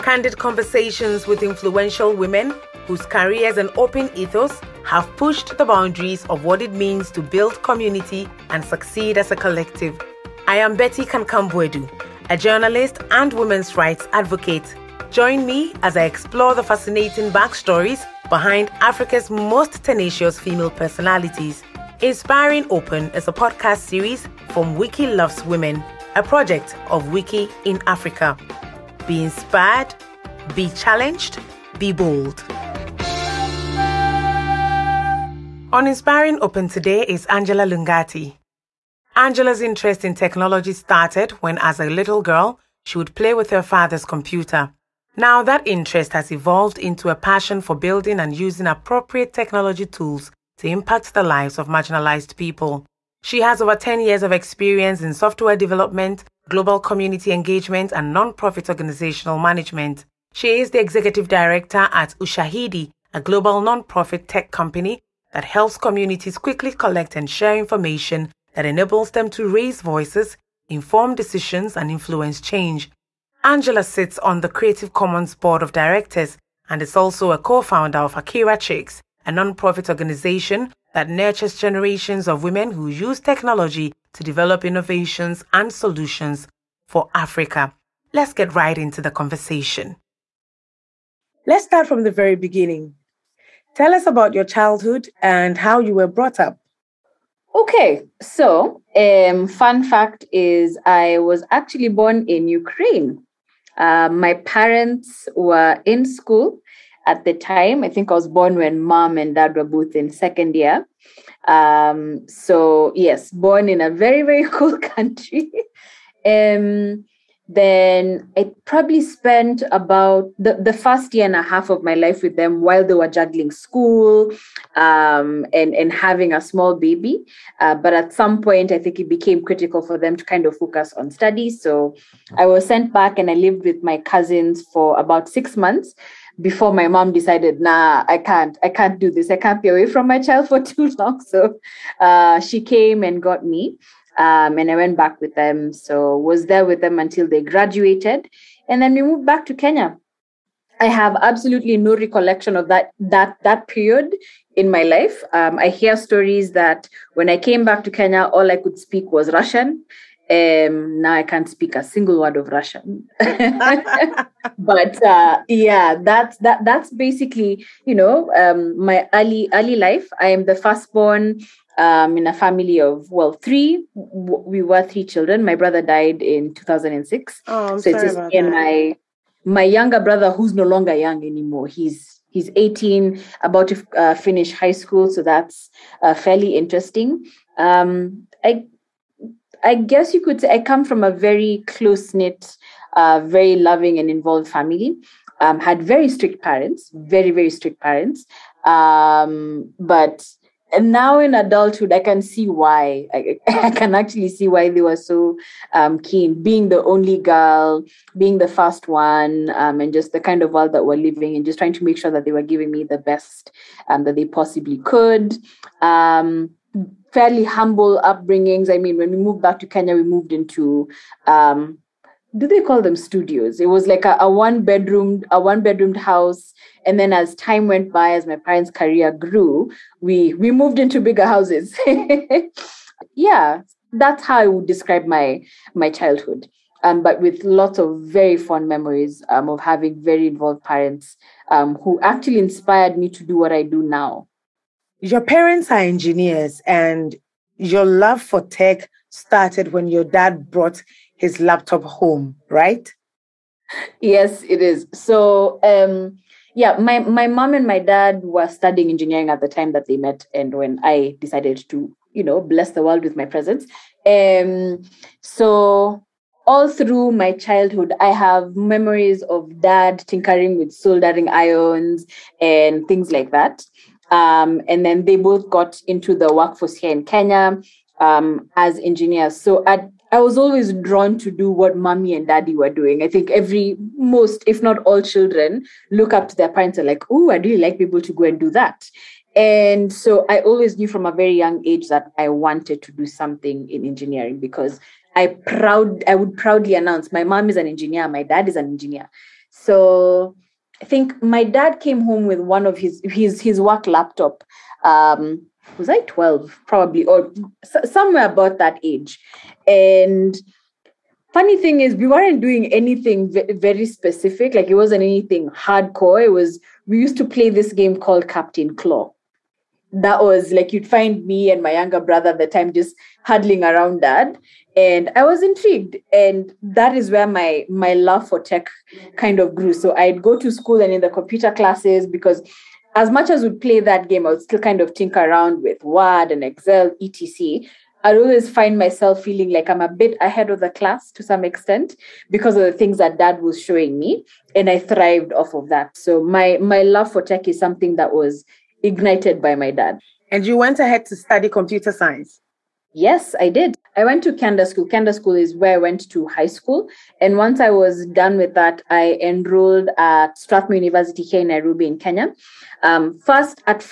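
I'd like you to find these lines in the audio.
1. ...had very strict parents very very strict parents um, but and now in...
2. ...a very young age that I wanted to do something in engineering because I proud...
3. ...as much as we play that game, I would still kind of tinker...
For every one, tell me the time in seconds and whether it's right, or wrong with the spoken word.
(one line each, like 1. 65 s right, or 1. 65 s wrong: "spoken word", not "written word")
1. 195 s right
2. 291 s right
3. 332 s right.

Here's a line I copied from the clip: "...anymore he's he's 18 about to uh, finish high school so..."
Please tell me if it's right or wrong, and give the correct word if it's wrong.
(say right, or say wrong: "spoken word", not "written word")
right.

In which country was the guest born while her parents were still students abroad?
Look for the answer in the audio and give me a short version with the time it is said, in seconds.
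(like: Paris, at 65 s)
Ukraine, at 102 s.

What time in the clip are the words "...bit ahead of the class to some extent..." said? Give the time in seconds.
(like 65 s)
339 s.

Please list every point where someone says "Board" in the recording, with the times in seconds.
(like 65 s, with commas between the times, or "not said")
75 s.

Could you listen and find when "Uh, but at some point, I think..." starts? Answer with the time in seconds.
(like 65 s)
127 s.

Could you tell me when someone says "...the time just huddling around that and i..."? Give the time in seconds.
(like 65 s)
322 s.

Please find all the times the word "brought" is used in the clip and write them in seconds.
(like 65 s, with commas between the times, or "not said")
96 s, 250 s.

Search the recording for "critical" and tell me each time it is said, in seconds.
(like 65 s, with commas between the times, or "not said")
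129 s.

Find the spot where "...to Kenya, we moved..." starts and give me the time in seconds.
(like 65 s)
219 s.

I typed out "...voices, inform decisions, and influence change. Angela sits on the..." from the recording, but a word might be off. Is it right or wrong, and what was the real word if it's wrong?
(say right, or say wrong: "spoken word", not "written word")
right.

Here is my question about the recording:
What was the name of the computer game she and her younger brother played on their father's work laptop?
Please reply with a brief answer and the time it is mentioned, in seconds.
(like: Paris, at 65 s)
Captain Claw, at 318 s.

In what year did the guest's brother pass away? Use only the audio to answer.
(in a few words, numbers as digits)
2006.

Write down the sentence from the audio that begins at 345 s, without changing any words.
So my my love for tech is something that was ignited by my dad.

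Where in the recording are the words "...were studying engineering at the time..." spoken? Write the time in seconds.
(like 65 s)
258 s.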